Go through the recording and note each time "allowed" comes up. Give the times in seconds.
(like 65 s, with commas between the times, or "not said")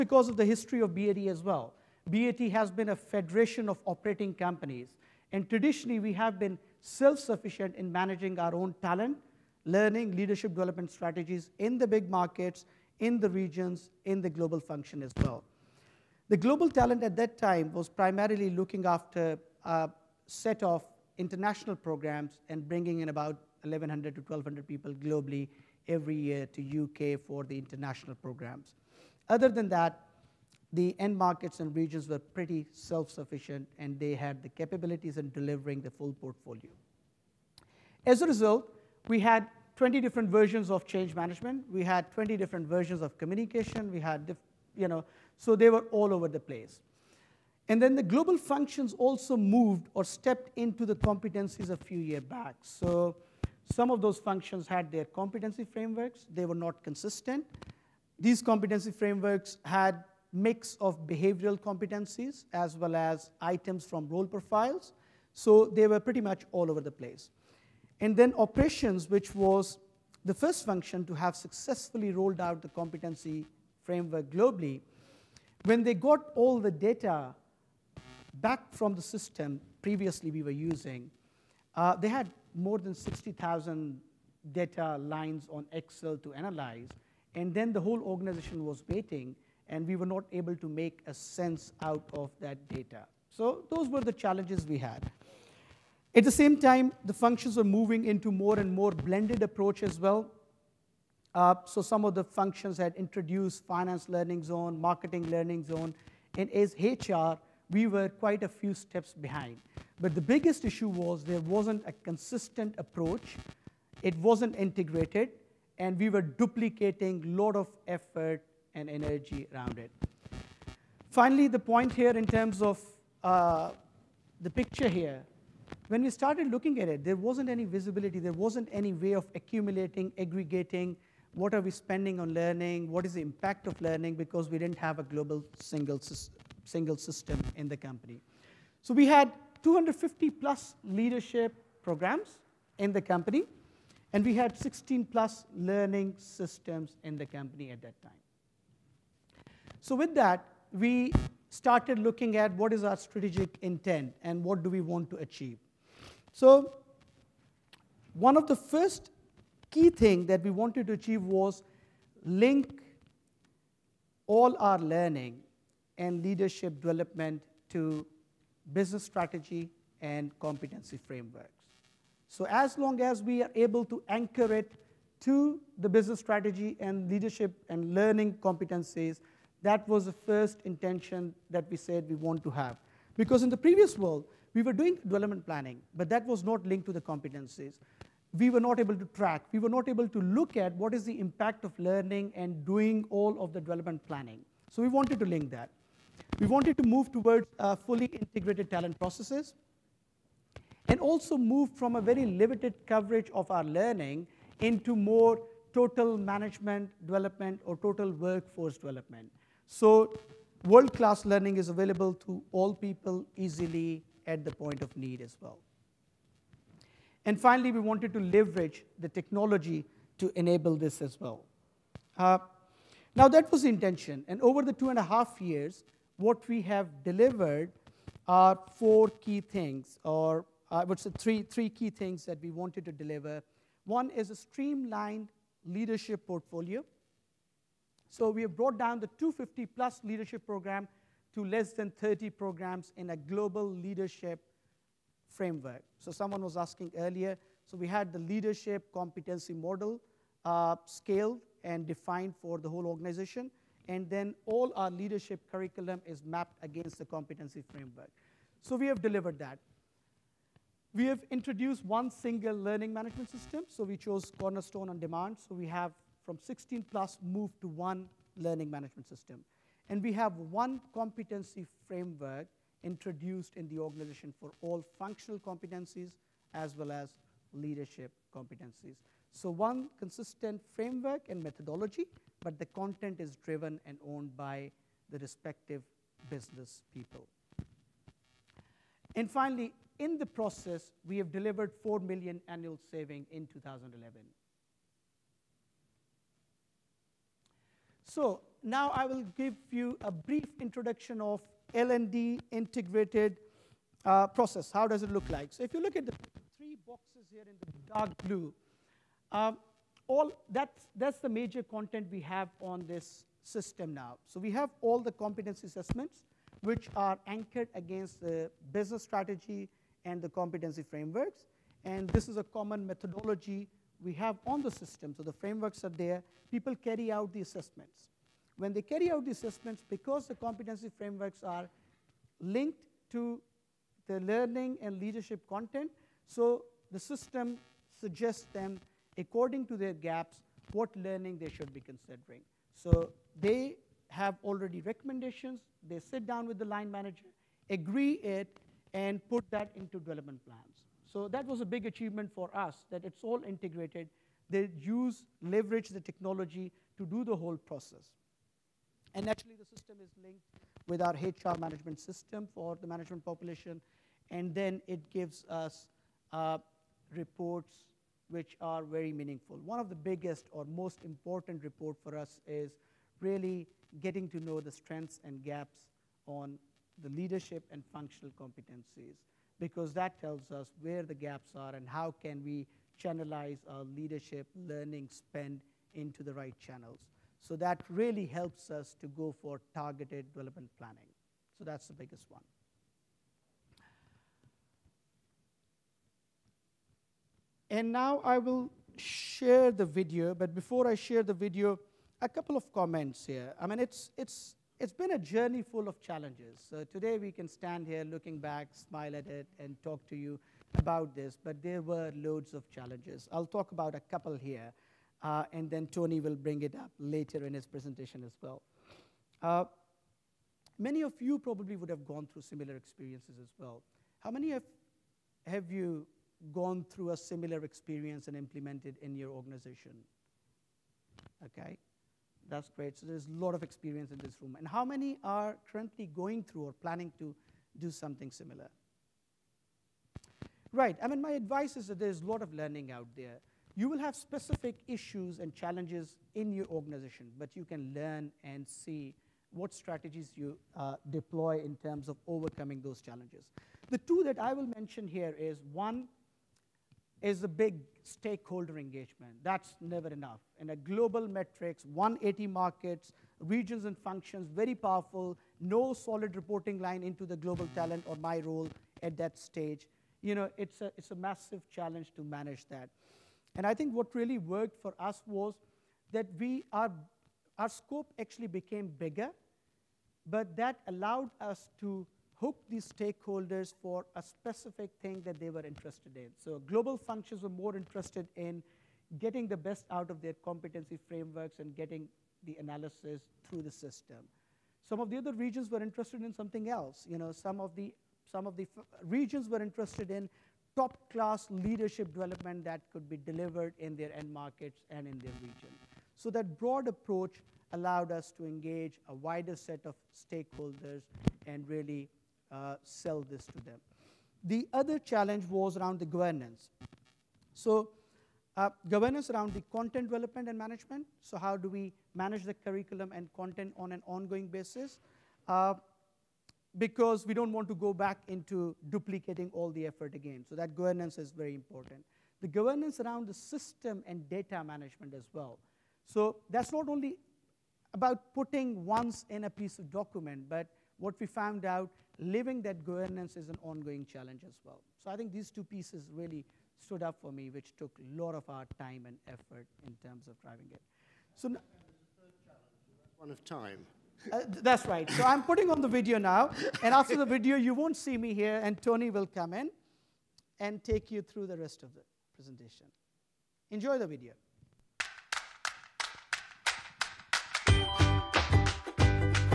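480 s, 507 s.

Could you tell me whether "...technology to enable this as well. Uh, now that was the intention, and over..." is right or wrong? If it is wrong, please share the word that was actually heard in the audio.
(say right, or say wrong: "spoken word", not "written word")
right.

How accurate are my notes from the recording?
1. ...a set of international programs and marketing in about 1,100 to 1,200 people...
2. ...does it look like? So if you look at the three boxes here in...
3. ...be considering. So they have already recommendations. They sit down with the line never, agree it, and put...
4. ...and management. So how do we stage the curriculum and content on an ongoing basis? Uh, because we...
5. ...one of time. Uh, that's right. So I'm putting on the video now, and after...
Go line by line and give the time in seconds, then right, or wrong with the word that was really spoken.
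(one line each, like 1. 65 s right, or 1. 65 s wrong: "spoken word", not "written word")
1. 19 s wrong: "bringing", not "marketing"
2. 304 s right
3. 341 s wrong: "manager", not "never"
4. 520 s wrong: "manage", not "stage"
5. 553 s right.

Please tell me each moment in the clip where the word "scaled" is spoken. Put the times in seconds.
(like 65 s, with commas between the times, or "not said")
250 s.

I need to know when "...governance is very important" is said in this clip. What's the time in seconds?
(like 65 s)
530 s.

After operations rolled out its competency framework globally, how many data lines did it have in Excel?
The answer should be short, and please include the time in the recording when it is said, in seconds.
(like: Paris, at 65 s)
60,000, at 82 s.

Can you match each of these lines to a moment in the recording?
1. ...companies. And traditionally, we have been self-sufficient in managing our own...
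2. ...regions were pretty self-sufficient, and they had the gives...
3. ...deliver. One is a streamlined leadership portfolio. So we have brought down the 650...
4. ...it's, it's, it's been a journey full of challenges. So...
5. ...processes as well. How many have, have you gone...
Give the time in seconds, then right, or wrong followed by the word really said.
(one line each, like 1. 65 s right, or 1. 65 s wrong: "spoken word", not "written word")
1. 4 s right
2. 31 s wrong: "capabilities", not "gives"
3. 232 s wrong: "250", not "650"
4. 403 s right
5. 422 s wrong: "experiences", not "processes".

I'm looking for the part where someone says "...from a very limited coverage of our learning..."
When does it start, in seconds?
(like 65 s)
201 s.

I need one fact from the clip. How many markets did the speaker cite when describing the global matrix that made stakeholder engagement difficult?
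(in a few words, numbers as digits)
180.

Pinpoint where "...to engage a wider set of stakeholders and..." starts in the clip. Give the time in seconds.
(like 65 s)
508 s.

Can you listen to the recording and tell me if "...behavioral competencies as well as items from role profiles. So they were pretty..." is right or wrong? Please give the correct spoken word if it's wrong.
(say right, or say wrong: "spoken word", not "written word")
right.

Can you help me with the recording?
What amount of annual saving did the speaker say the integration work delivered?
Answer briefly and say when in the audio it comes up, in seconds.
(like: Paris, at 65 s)
4 million, at 291 s.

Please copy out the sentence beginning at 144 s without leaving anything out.
And we had 16 plus learning systems in the company at that time.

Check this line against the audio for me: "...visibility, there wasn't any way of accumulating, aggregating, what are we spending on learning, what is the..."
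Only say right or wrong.
right.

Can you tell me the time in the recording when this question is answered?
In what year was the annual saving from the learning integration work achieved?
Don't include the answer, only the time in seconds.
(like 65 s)
293 s.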